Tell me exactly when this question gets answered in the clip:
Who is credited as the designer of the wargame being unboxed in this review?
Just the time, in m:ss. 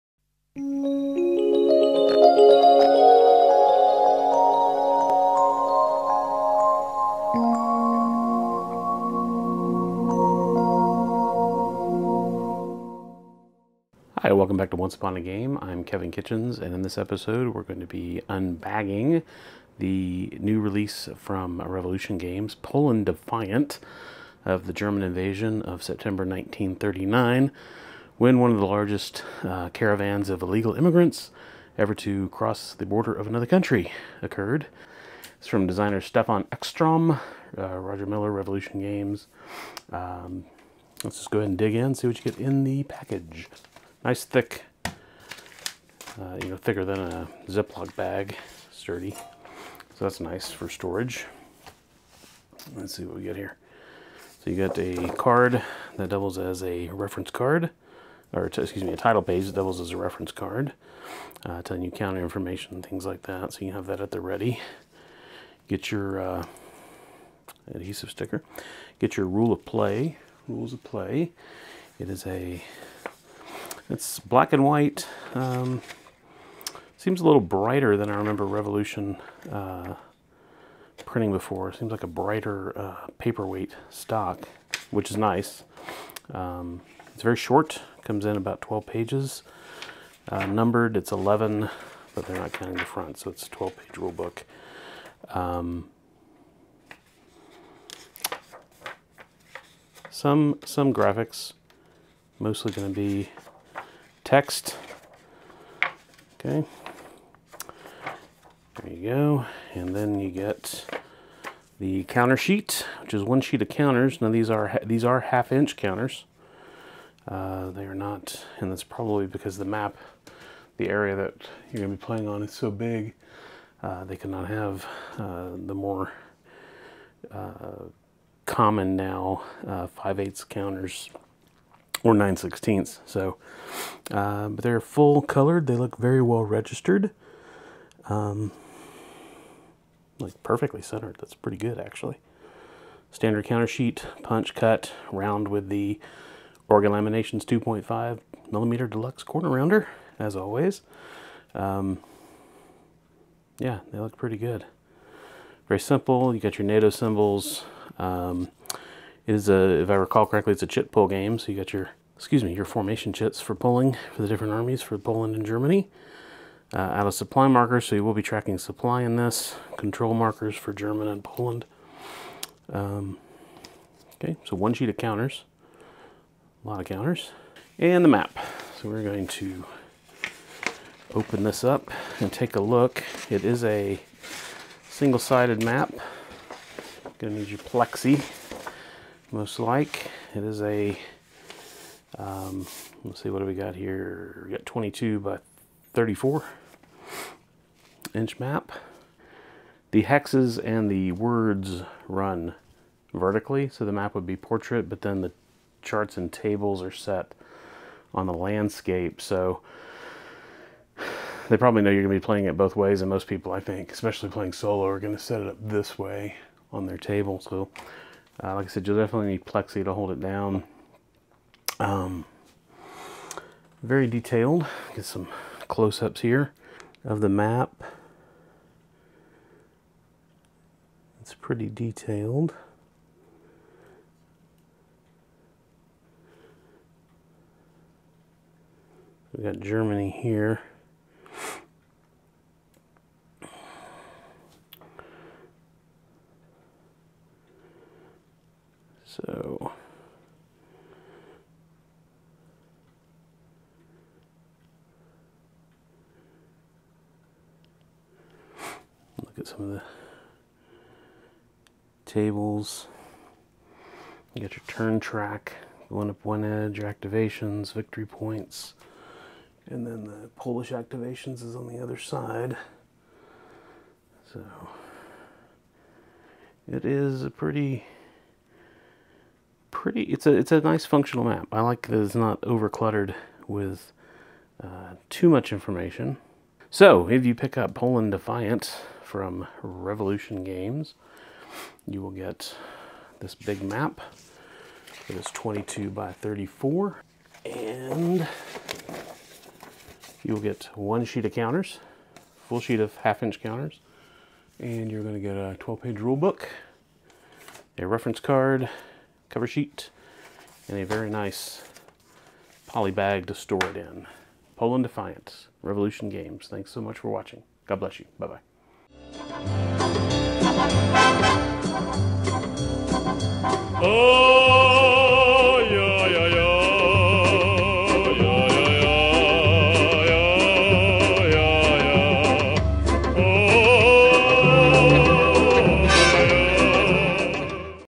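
0:35.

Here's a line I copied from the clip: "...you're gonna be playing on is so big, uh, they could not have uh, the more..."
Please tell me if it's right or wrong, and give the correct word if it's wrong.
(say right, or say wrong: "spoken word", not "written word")
right.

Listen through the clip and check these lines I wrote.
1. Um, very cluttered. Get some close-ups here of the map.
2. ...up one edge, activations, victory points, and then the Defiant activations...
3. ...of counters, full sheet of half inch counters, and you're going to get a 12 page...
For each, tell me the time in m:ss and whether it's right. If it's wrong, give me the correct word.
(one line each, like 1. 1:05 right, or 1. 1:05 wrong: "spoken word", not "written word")
1. 3:41 wrong: "detailed", not "cluttered"
2. 4:26 wrong: "Polish", not "Defiant"
3. 5:01 right.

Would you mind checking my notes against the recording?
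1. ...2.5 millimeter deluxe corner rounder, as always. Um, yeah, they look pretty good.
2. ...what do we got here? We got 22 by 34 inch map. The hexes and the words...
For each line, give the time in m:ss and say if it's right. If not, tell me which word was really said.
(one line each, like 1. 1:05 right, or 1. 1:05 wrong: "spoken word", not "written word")
1. 2:27 right
2. 3:13 right.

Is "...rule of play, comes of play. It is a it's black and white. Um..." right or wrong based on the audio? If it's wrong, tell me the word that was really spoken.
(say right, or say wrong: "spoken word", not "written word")
wrong: "rules", not "comes".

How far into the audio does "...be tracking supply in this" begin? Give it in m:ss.
2:48.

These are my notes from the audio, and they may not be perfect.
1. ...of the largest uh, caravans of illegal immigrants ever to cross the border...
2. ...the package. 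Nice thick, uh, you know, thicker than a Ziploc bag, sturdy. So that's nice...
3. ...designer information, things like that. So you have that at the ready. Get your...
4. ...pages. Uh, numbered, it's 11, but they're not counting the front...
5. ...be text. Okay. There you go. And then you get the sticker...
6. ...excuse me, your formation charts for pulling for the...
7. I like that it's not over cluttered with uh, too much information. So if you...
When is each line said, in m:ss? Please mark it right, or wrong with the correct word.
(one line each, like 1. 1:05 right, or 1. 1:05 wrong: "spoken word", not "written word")
1. 0:28 right
2. 0:42 right
3. 1:01 wrong: "counter", not "designer"
4. 1:28 right
5. 1:42 wrong: "counter", not "sticker"
6. 2:42 wrong: "chits", not "charts"
7. 4:41 right.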